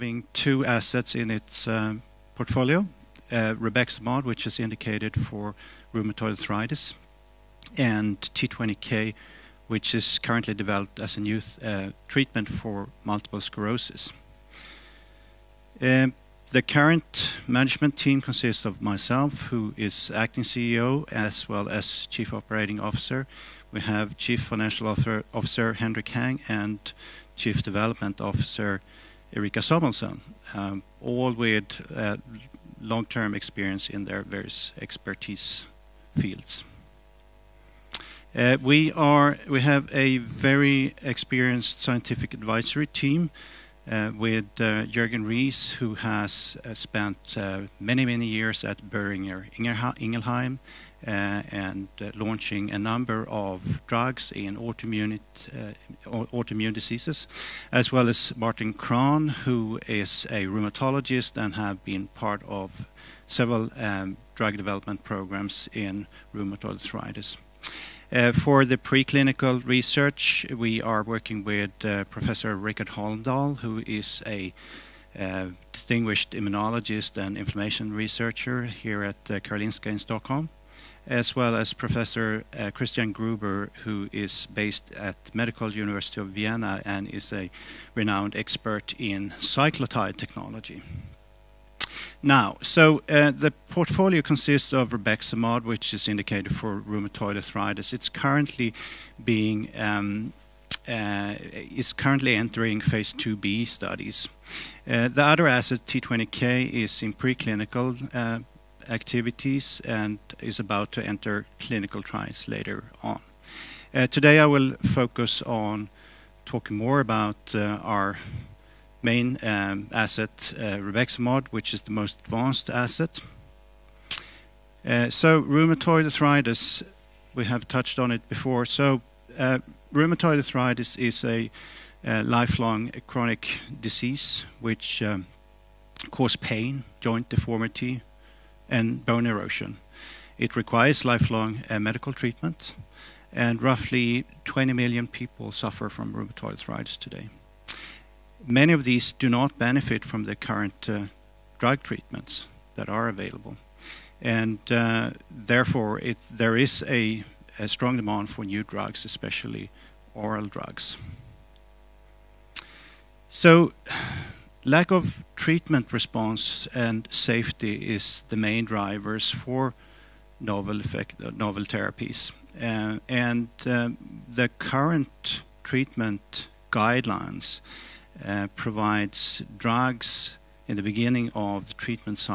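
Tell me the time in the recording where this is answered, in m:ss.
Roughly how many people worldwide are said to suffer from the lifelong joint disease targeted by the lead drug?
2:24.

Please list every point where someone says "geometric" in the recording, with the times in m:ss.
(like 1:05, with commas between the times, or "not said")
not said.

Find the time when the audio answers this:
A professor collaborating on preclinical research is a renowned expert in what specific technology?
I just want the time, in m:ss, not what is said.
1:29.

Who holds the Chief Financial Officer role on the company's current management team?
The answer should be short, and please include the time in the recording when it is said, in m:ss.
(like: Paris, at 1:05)
Henrik Hang, at 0:25.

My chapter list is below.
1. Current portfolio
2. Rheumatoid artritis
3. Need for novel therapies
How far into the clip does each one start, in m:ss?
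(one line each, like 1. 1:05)
1. 1:32
2. 2:04
3. 2:43.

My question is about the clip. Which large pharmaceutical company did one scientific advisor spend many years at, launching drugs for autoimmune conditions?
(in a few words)
Boehringer Ingelheim.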